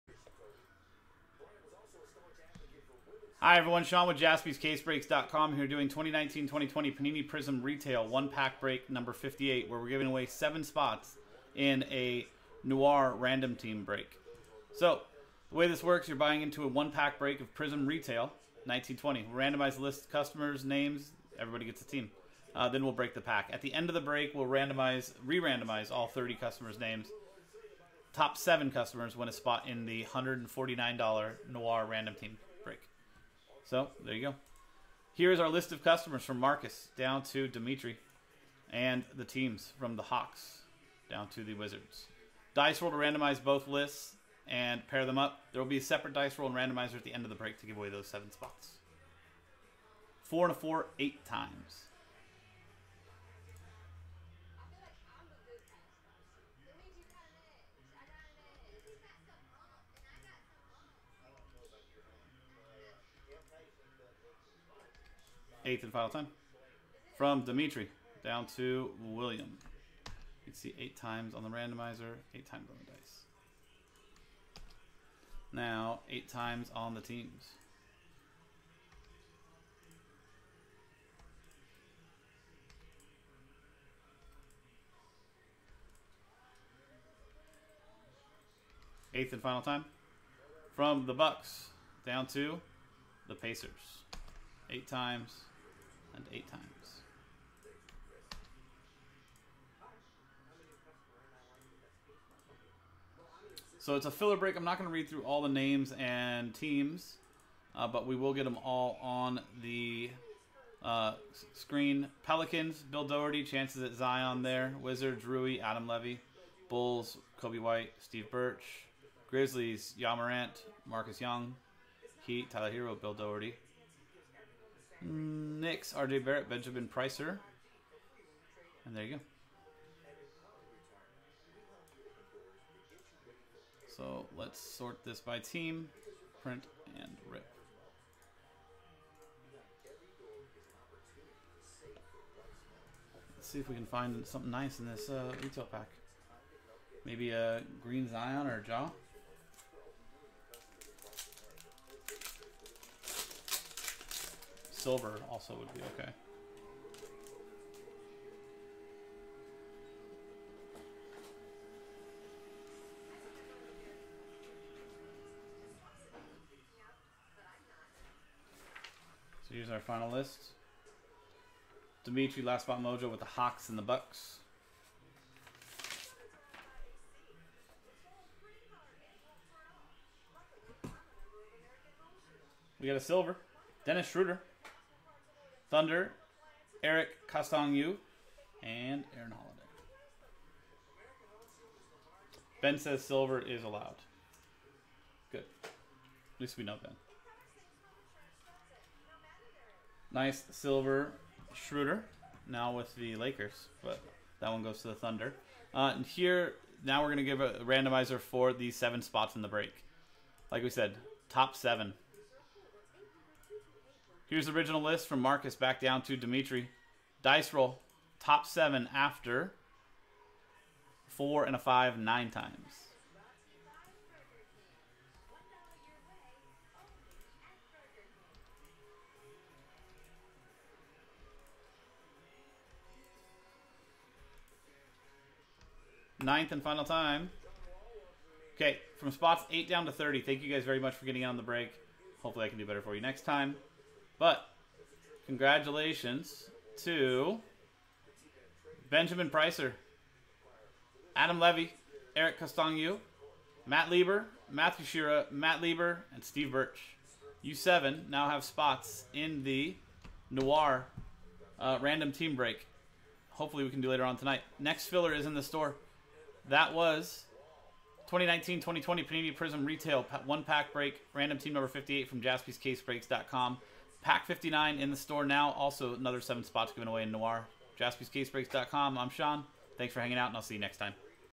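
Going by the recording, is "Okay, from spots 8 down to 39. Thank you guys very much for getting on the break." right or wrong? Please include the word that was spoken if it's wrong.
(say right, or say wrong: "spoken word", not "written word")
wrong: "30", not "39".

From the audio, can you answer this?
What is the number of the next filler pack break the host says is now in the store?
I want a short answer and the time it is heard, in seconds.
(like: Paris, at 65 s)
59, at 274 s.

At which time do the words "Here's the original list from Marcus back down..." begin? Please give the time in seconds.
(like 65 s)
214 s.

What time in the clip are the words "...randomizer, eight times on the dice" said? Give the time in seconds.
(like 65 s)
71 s.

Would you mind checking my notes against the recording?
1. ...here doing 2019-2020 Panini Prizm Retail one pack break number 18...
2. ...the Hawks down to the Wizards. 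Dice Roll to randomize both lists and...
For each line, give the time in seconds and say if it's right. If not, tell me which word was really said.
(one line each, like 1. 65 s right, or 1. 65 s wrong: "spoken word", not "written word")
1. 5 s wrong: "58", not "18"
2. 39 s right.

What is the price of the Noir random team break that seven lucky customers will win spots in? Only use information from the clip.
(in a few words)
$149.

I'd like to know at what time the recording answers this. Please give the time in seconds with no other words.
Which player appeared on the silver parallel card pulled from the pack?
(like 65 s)
183 s.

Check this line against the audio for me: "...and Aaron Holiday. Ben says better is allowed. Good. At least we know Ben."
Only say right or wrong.
wrong.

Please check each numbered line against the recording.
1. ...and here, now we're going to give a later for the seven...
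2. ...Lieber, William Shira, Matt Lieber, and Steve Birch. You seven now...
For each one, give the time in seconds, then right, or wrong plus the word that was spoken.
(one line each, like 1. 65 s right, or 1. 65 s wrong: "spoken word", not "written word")
1. 205 s wrong: "randomizer", not "later"
2. 253 s wrong: "Matthew", not "William".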